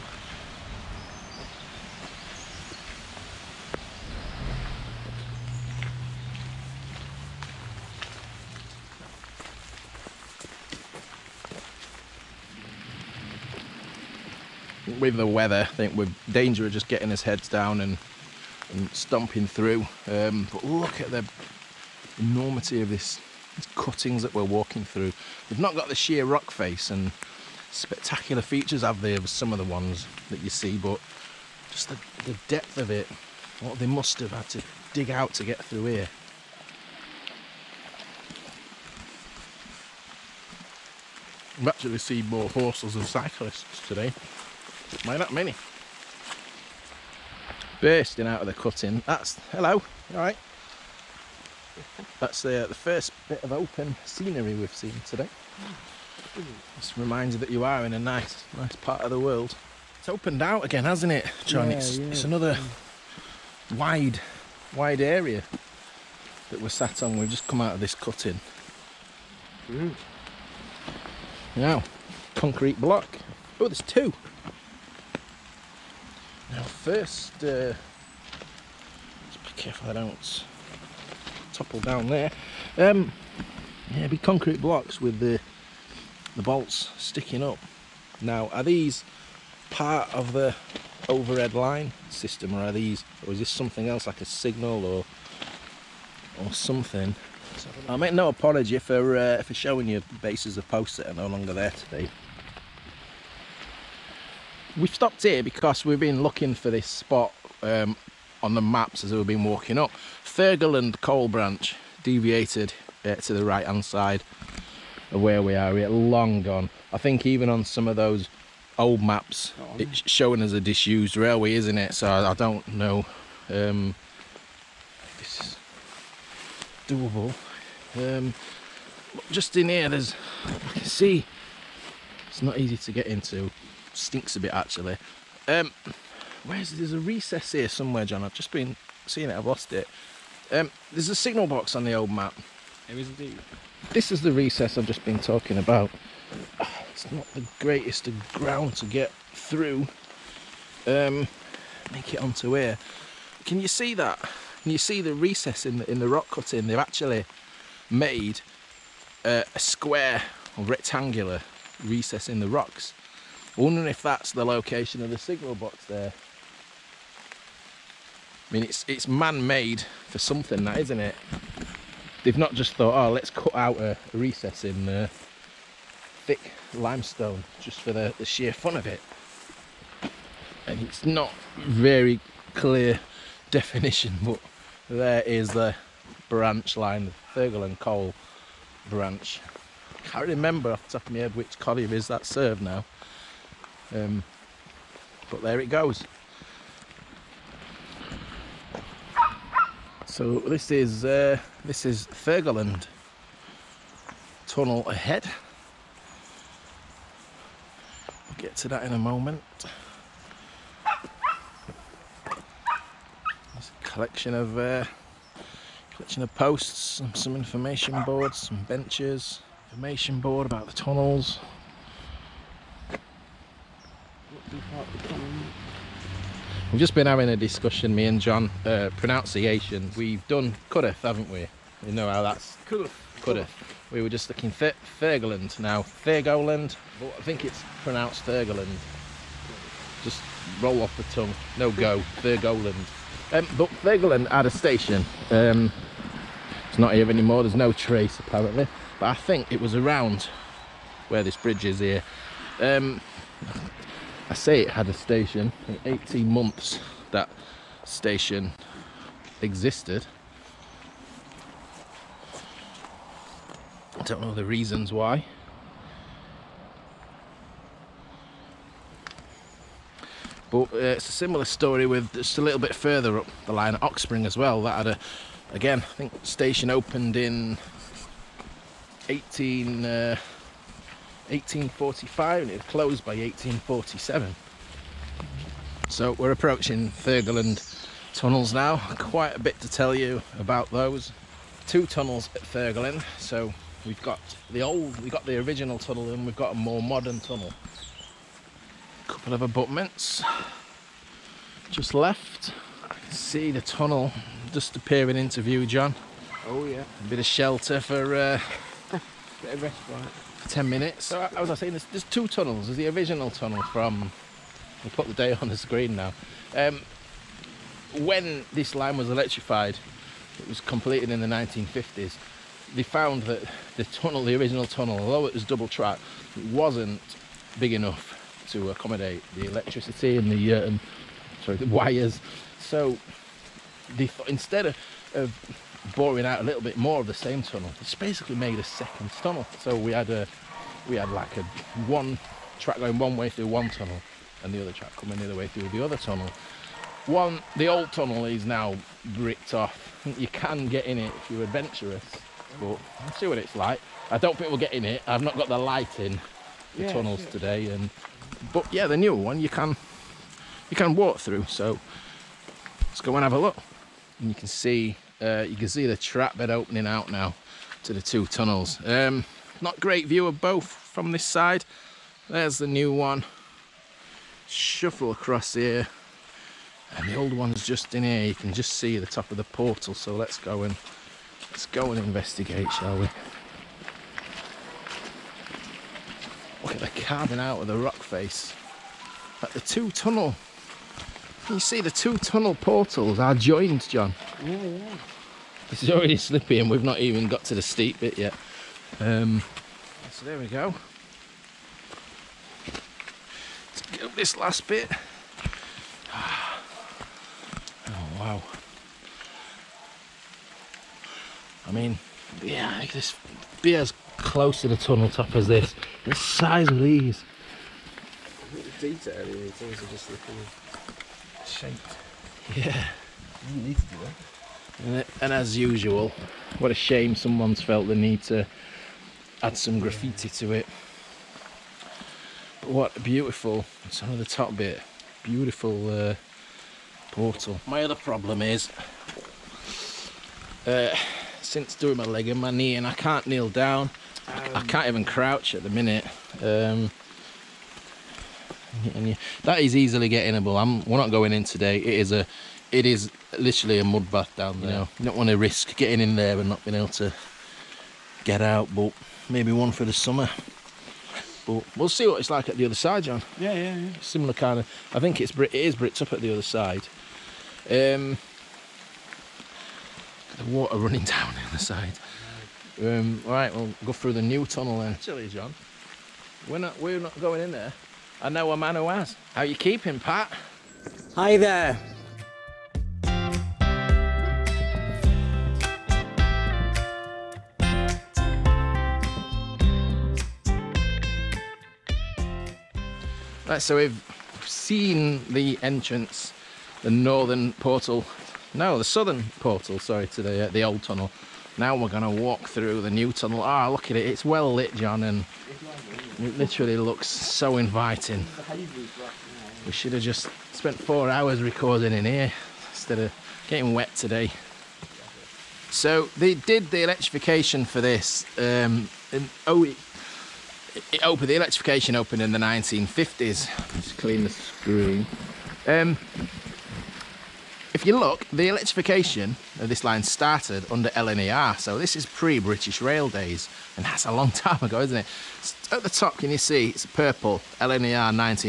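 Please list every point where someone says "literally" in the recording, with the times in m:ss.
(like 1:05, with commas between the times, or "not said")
7:33, 8:26.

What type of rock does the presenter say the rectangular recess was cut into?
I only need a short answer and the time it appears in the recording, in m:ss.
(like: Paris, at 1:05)
Limestone, at 2:56.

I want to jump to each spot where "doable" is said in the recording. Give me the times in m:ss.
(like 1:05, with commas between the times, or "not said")
2:06.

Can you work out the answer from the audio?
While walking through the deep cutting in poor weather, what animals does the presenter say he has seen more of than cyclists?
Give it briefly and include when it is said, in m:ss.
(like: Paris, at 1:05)
Horses, at 0:42.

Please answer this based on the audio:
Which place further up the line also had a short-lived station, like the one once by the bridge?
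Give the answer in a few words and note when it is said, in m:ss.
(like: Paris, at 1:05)
Oxspring, at 4:33.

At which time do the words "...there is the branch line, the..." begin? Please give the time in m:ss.
3:04.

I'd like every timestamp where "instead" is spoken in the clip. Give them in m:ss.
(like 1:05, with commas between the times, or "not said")
5:34, 8:32.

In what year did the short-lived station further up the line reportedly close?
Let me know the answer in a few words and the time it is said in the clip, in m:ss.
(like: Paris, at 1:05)
1847, at 4:43.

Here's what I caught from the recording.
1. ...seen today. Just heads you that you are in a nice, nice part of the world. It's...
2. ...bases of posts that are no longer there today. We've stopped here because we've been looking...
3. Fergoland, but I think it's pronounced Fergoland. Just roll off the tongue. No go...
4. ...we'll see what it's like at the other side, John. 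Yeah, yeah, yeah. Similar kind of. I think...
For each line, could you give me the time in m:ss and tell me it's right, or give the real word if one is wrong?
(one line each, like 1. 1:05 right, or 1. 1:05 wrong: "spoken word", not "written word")
1. 0:54 wrong: "reminds", not "heads"
2. 1:40 right
3. 3:55 right
4. 7:41 right.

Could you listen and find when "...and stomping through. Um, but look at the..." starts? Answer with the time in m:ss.
0:18.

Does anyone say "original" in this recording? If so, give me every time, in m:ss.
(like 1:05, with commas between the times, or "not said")
4:55, 5:12, 5:24.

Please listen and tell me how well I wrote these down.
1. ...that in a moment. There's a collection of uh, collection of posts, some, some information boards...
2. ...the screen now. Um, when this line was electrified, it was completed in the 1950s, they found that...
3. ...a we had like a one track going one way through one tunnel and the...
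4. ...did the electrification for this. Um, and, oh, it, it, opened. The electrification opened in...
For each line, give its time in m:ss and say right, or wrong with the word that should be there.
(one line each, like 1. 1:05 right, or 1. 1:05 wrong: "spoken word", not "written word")
1. 3:28 right
2. 5:15 right
3. 5:40 right
4. 8:36 right.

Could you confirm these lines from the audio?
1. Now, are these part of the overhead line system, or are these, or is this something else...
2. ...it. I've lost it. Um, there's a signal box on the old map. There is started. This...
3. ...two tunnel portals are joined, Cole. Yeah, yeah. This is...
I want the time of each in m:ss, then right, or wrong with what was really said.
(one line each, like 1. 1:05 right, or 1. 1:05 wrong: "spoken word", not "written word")
1. 1:28 right
2. 2:19 wrong: "indeed", not "started"
3. 6:31 wrong: "John", not "Cole".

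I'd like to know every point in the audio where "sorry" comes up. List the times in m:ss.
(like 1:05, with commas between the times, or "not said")
5:31, 8:19.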